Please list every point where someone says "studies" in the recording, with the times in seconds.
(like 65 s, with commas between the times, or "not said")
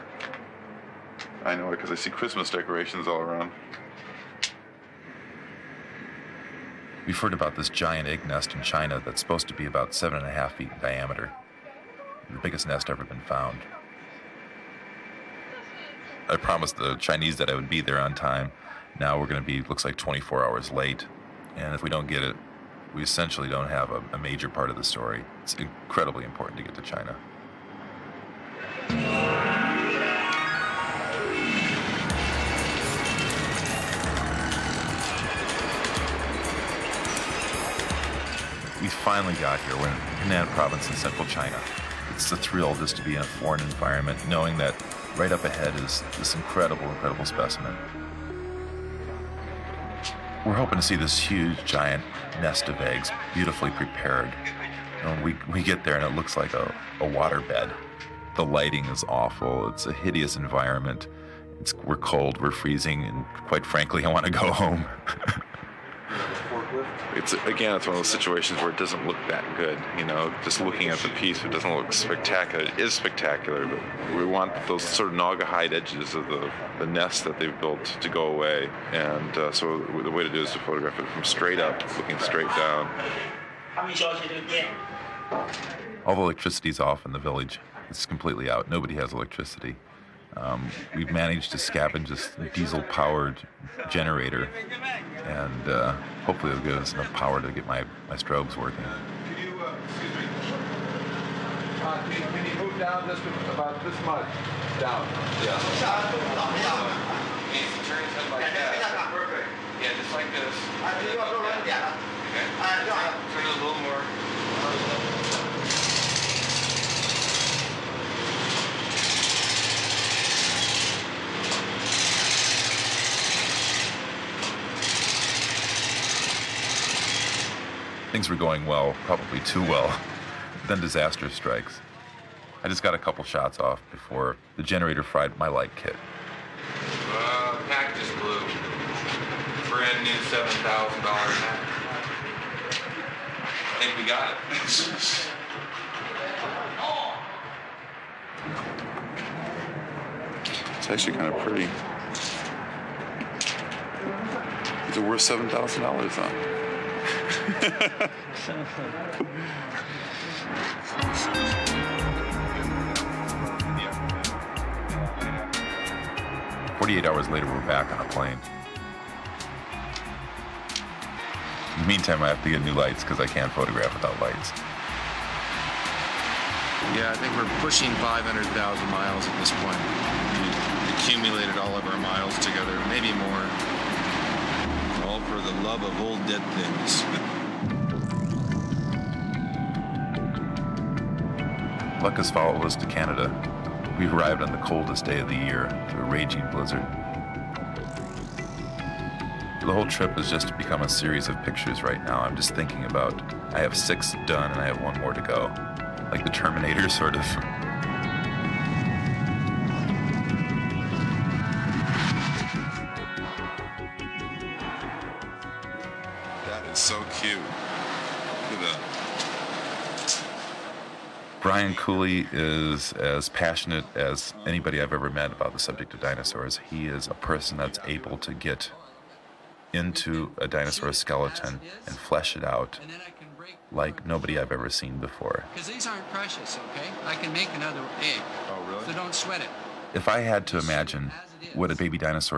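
not said.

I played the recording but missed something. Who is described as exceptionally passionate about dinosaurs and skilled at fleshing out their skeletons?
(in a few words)
Brian Cooley.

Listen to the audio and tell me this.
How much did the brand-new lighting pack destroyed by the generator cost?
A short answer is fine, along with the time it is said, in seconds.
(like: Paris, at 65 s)
$7,000, at 140 s.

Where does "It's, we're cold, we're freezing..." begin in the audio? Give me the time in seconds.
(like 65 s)
61 s.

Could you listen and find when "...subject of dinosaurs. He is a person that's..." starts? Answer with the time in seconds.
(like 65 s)
225 s.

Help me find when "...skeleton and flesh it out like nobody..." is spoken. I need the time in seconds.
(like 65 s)
230 s.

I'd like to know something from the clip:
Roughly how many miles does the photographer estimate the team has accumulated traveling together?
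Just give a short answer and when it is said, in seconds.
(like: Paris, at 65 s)
500,000, at 177 s.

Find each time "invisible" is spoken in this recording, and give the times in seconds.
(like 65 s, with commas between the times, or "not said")
not said.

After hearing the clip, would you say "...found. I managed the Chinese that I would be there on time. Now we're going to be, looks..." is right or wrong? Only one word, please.
wrong.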